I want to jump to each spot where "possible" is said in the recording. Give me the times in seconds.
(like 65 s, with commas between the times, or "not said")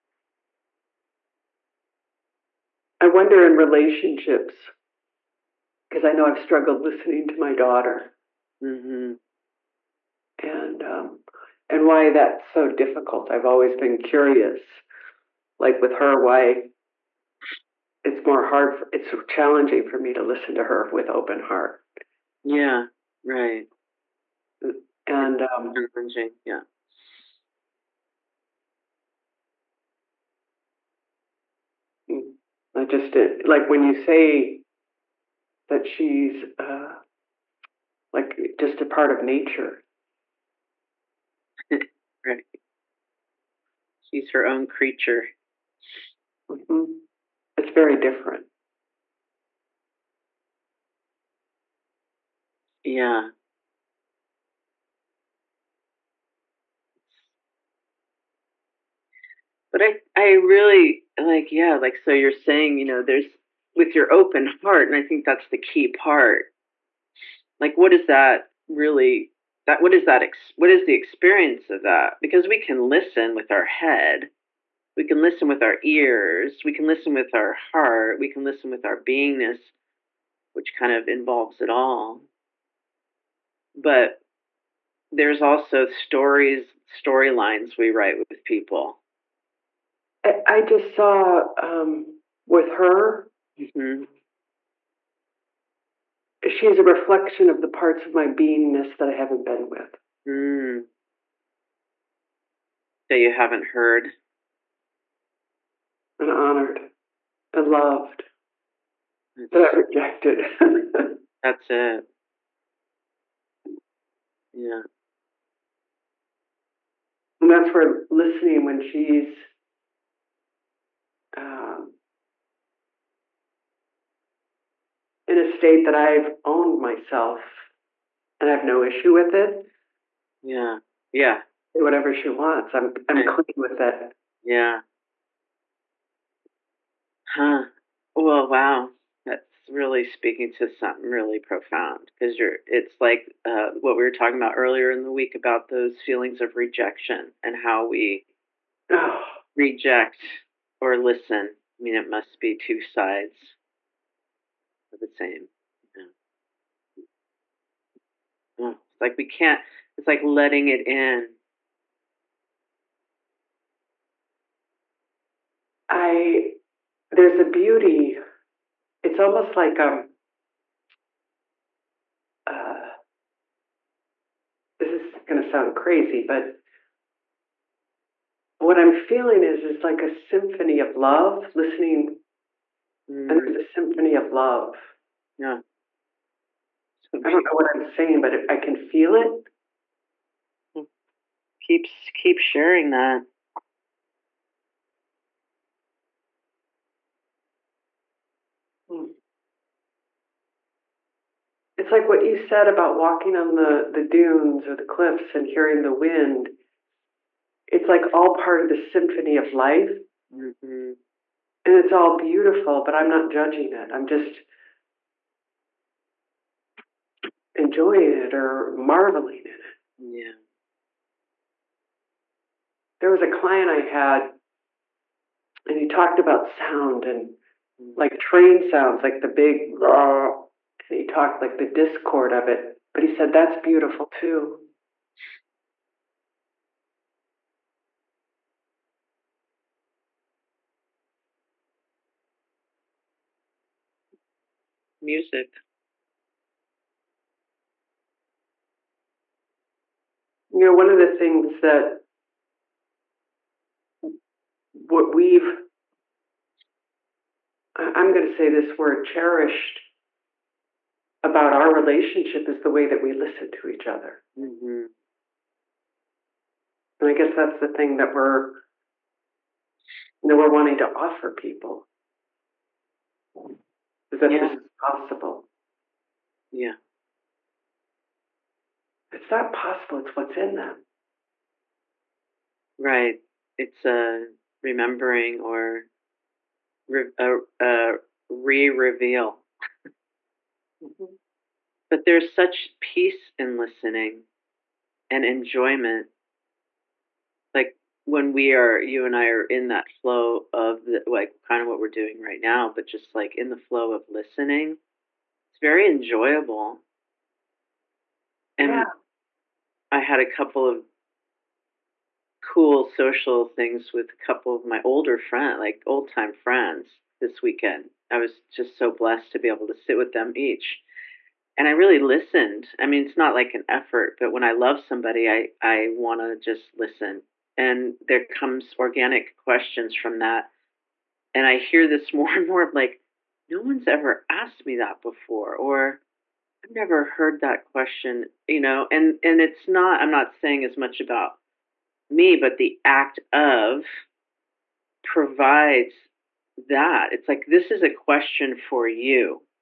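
274 s, 279 s.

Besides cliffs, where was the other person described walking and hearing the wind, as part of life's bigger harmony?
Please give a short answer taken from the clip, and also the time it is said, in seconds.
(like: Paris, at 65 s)
Dunes, at 204 s.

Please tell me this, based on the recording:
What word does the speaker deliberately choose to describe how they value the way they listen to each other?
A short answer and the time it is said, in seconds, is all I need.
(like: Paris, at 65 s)
Cherished, at 259 s.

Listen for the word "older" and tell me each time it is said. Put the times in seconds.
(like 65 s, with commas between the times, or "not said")
314 s.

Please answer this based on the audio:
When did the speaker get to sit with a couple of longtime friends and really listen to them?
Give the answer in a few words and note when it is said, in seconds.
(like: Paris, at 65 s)
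This weekend, at 317 s.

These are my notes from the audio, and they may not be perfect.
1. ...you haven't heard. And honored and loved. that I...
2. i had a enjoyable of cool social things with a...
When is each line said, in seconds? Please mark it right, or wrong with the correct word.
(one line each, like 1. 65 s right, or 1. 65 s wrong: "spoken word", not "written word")
1. 103 s right
2. 309 s wrong: "couple", not "enjoyable".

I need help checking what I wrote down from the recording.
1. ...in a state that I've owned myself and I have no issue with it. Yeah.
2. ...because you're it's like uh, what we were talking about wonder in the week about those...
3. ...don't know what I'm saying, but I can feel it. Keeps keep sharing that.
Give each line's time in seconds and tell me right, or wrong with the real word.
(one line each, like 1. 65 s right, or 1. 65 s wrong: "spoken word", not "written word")
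1. 125 s right
2. 142 s wrong: "earlier", not "wonder"
3. 187 s right.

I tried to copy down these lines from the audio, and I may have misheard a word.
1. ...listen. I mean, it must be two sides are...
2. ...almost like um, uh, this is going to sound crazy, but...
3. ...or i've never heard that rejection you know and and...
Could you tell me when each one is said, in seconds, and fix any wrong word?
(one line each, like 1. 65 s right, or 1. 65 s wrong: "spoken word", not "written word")
1. 150 s right
2. 169 s right
3. 335 s wrong: "question", not "rejection".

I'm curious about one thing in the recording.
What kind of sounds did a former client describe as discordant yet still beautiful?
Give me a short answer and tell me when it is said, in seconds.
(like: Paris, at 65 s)
Train sounds, at 228 s.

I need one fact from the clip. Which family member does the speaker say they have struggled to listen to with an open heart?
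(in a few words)
Daughter.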